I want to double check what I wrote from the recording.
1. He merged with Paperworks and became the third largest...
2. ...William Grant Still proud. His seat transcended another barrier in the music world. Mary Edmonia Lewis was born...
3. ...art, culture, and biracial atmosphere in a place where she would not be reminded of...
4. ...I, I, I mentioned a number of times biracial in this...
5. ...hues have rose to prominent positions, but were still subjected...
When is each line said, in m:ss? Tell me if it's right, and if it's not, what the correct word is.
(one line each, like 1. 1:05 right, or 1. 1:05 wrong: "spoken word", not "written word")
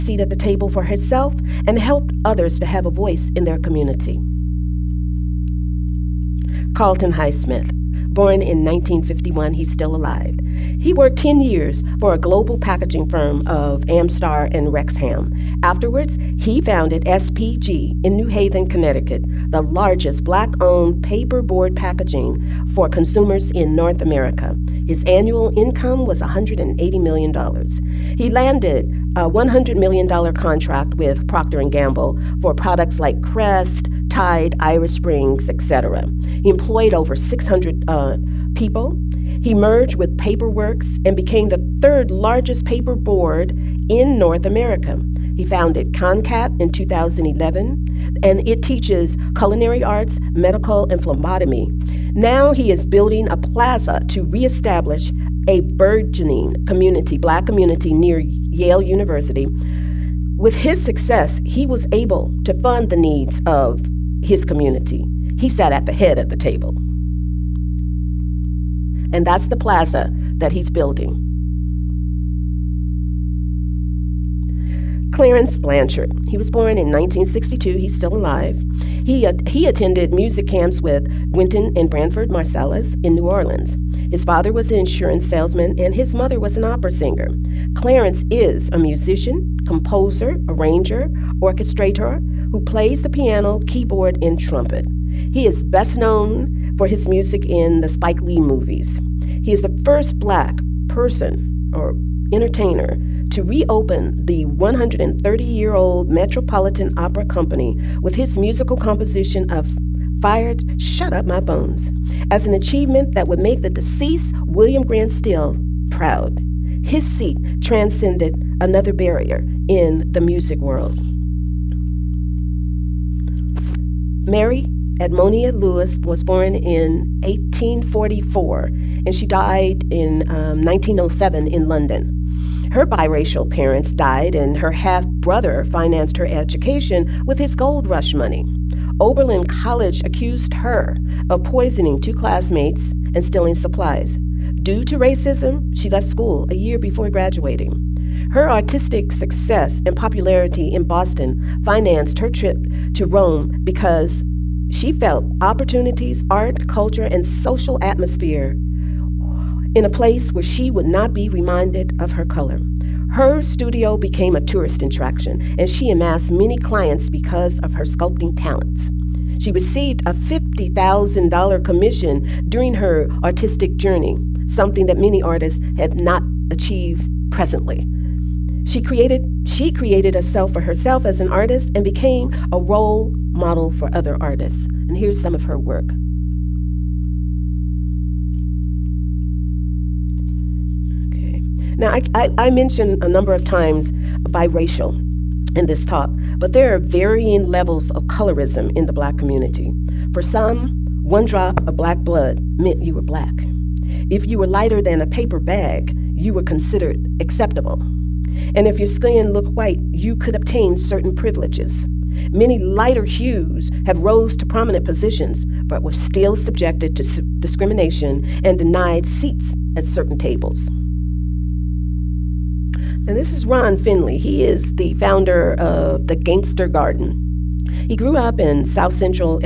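1. 0:39 right
2. 1:54 right
3. 2:36 wrong: "social", not "biracial"
4. 3:11 right
5. 3:33 right.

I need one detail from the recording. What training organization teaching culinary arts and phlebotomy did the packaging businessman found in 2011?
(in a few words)
ConnCAT.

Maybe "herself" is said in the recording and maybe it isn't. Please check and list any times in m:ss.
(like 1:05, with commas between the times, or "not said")
0:00, 3:00.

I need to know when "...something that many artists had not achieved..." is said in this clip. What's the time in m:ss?
2:54.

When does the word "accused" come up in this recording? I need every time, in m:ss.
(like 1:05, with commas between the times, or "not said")
2:20.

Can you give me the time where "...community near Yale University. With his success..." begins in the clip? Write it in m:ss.
0:57.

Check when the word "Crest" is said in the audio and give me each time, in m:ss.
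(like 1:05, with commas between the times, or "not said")
0:33.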